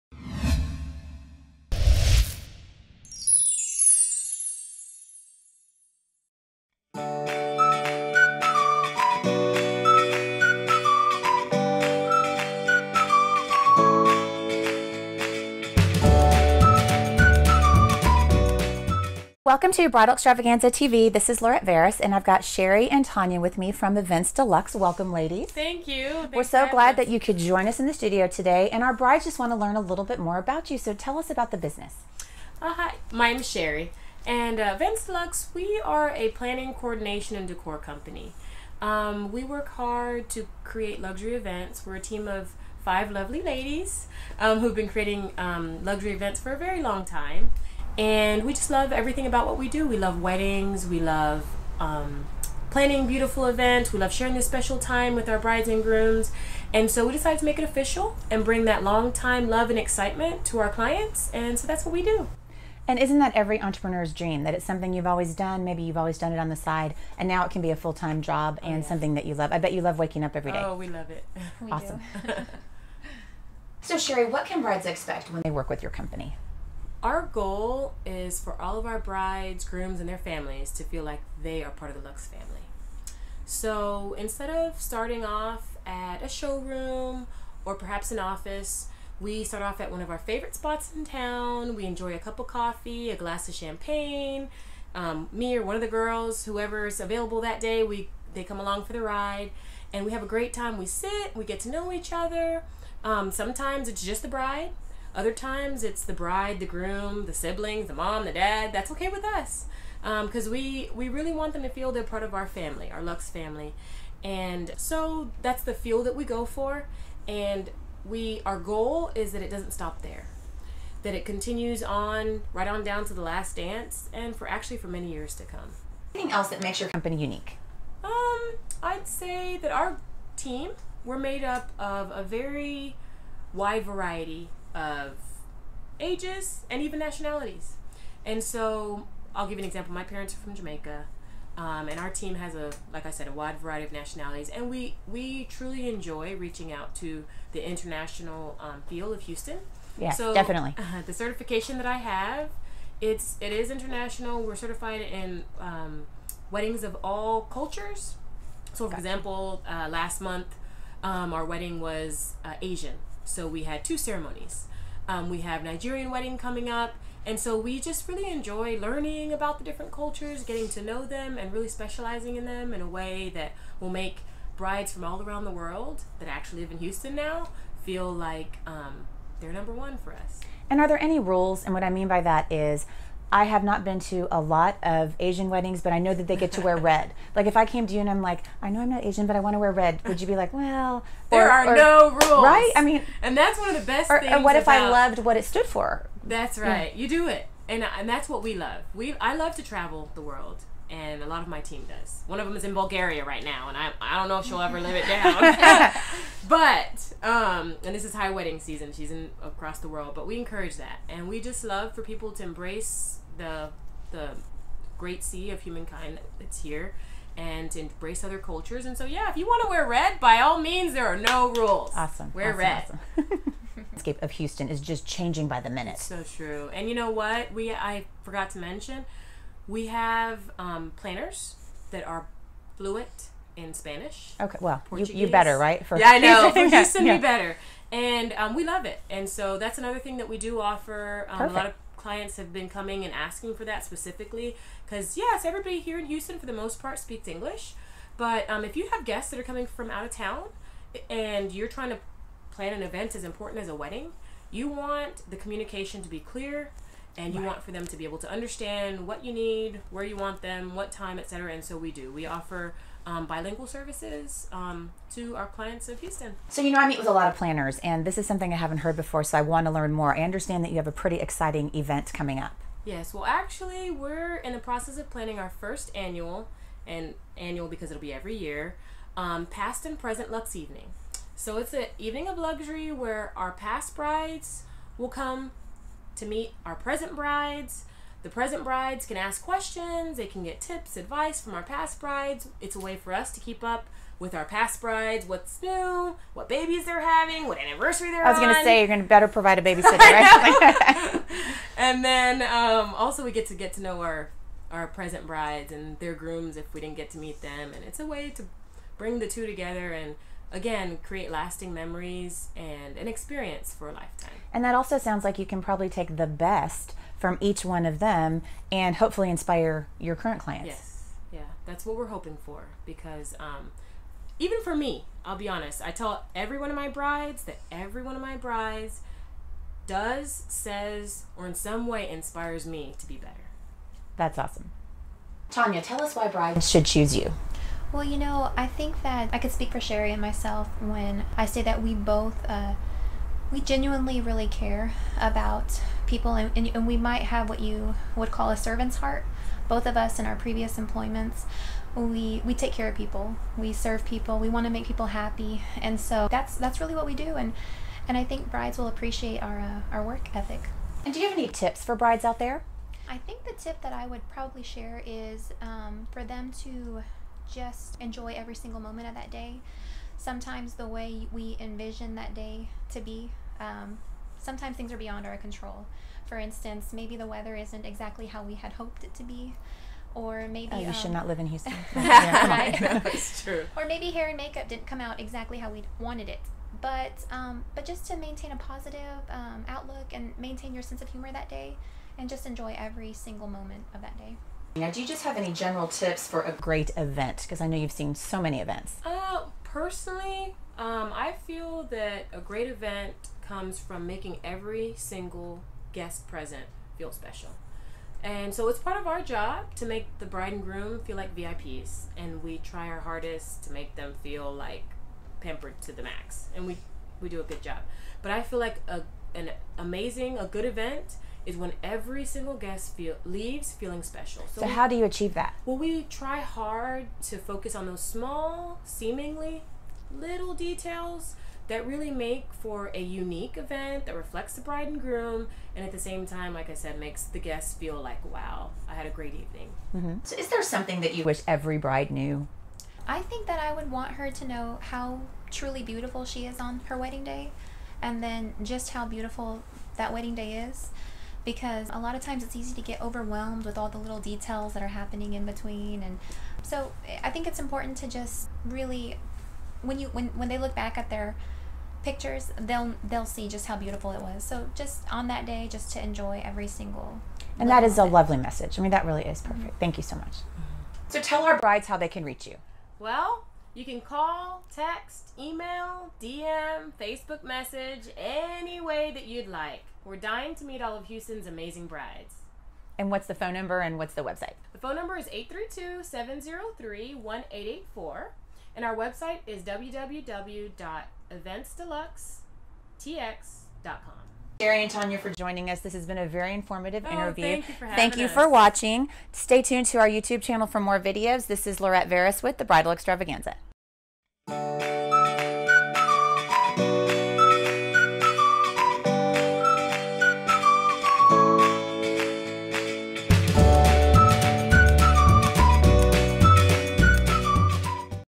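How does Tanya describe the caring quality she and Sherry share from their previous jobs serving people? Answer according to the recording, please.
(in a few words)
A servant's heart.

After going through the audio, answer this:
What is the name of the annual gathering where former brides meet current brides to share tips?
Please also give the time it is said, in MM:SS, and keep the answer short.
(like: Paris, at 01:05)
Past and Present Lux Evening, at 04:39.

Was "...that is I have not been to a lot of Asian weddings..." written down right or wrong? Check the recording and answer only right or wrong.
right.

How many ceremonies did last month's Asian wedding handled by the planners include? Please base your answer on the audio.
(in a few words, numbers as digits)
2.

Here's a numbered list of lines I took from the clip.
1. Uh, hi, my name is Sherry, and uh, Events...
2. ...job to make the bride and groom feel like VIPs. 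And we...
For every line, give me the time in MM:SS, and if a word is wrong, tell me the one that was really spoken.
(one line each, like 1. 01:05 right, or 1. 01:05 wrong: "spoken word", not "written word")
1. 00:32 right
2. 06:49 right.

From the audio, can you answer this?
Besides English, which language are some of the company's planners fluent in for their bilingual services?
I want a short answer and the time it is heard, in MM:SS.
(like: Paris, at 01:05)
Spanish, at 03:53.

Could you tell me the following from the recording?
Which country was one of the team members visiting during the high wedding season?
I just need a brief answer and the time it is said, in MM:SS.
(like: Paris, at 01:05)
Bulgaria, at 03:22.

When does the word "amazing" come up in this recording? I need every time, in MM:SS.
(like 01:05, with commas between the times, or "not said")
06:59, 08:01.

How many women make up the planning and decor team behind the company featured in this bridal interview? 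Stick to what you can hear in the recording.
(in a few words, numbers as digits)
5.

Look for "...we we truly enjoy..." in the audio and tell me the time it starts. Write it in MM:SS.
02:24.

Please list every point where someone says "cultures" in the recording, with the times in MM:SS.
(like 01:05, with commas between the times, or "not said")
02:37, 02:49, 03:38.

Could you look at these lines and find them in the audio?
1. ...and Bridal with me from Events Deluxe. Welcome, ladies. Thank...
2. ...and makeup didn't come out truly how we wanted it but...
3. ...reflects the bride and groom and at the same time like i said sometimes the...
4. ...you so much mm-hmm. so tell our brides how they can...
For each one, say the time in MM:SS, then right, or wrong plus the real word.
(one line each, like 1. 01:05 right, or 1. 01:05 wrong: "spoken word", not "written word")
1. 00:22 wrong: "Tanya", not "Bridal"
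2. 06:24 wrong: "exactly", not "truly"
3. 07:14 wrong: "makes", not "sometimes"
4. 07:49 right.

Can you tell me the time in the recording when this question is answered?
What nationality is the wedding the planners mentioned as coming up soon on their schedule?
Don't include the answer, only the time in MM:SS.
02:45.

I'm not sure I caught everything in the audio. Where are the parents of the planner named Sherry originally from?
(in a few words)
Jamaica.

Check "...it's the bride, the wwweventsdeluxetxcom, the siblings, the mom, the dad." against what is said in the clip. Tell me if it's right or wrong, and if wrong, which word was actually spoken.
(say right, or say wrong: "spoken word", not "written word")
wrong: "groom", not "wwweventsdeluxetxcom".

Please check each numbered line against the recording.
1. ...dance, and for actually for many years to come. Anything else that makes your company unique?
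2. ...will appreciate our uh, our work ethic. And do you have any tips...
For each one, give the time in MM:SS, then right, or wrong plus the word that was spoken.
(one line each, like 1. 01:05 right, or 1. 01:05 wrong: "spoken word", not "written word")
1. 02:03 right
2. 05:58 right.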